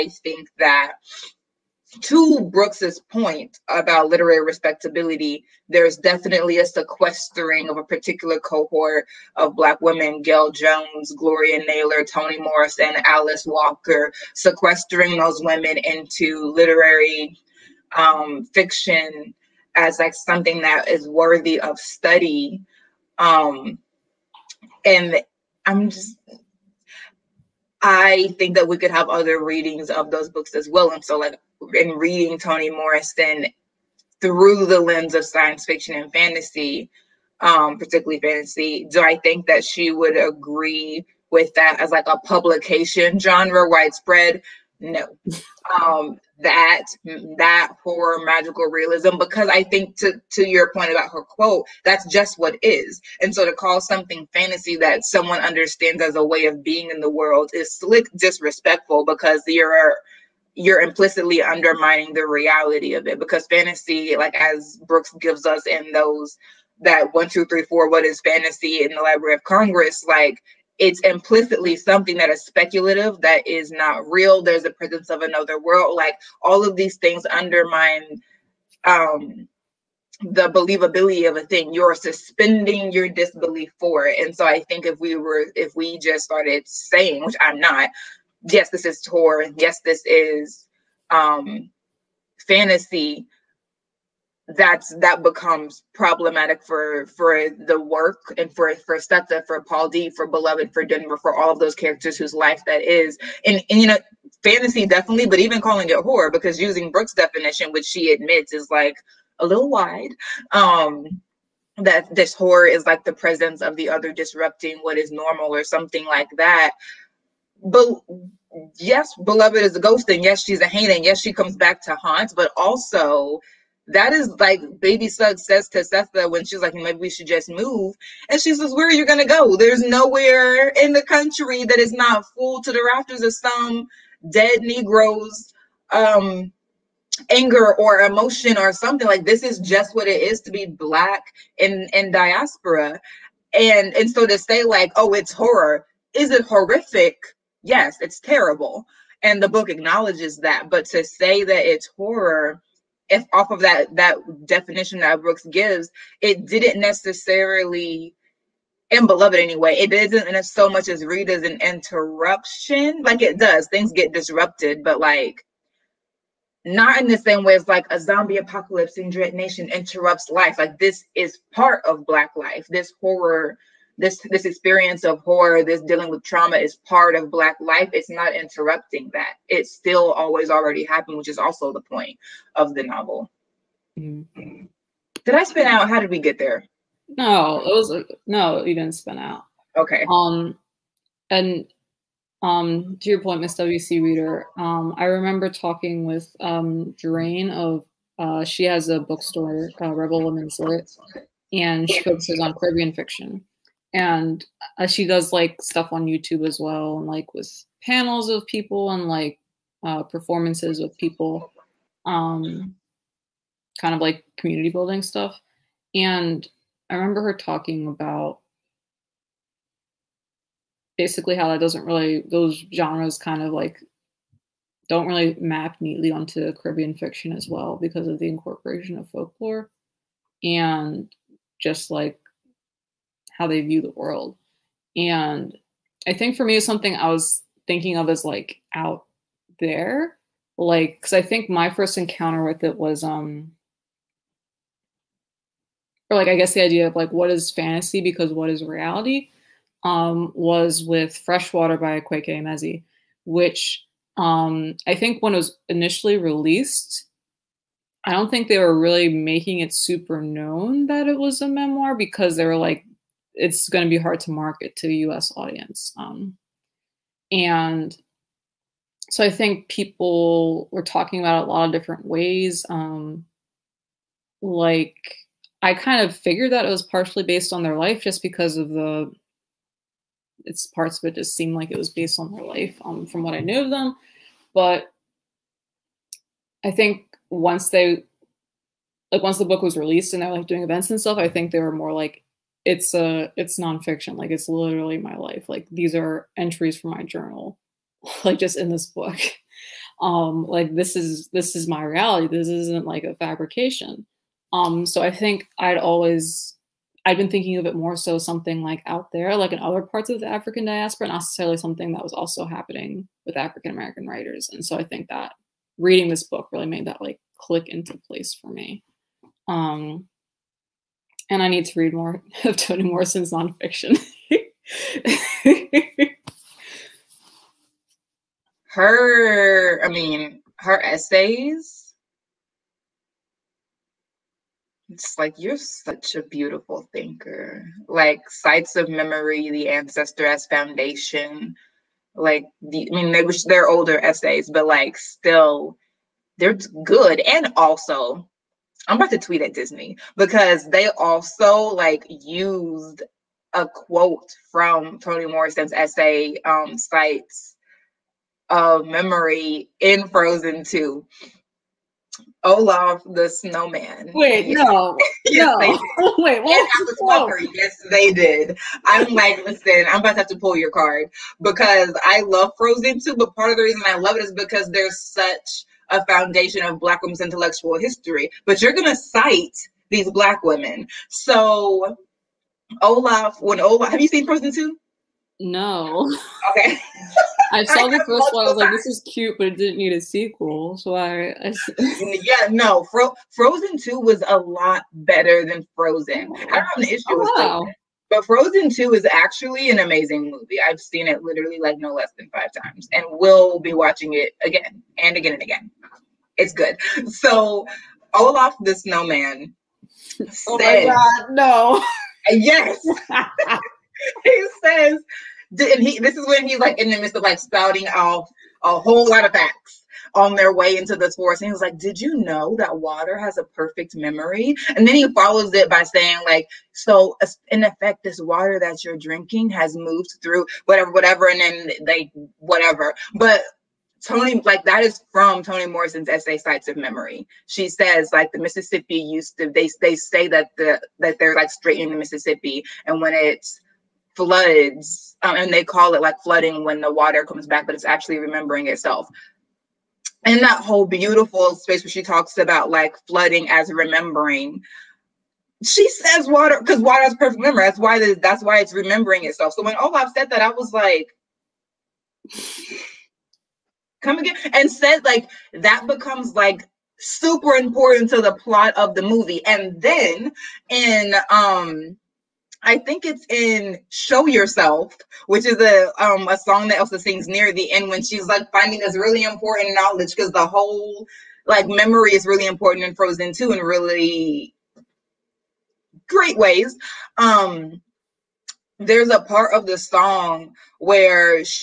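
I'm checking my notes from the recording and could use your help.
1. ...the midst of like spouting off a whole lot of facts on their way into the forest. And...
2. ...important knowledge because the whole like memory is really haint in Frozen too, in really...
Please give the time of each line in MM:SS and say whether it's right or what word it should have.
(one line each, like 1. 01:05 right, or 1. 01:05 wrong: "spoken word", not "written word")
1. 06:56 right
2. 07:59 wrong: "important", not "haint".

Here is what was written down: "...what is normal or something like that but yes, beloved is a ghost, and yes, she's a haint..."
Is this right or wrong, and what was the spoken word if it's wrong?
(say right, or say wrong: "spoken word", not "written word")
right.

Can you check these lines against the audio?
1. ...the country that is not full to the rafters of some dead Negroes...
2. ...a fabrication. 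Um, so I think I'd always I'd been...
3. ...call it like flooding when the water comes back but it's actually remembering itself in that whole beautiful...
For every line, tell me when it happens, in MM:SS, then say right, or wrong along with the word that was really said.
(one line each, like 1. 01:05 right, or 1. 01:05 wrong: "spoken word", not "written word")
1. 02:10 right
2. 05:03 right
3. 07:25 right.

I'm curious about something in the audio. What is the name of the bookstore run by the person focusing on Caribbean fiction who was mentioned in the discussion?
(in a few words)
Rebel Women's Lit.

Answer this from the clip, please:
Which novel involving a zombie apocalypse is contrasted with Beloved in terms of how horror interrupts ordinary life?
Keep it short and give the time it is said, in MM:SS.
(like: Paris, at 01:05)
Dread Nation, at 02:49.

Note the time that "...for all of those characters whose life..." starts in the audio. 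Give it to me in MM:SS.
01:41.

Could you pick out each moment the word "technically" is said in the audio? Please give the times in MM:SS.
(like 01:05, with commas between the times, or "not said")
not said.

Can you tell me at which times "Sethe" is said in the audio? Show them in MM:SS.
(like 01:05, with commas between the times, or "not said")
01:38, 02:05.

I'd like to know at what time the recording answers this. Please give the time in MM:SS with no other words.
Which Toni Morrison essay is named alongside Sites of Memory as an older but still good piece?
05:39.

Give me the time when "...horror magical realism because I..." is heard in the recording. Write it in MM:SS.
00:47.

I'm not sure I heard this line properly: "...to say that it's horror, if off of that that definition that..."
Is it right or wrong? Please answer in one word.
right.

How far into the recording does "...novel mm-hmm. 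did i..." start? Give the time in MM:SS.
03:02.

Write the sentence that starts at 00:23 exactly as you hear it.
Um, and I'm just, I think that we could have other readings of those books as well.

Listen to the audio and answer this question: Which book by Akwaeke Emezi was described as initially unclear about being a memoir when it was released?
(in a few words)
Freshwater.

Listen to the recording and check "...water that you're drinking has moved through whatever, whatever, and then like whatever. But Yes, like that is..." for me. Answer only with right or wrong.
wrong.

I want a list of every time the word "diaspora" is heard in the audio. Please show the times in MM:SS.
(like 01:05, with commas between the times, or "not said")
02:22, 05:10.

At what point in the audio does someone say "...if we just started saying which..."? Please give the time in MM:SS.
01:25.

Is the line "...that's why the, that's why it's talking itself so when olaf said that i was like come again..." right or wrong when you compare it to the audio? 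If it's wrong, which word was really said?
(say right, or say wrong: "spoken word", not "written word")
wrong: "remembering", not "talking".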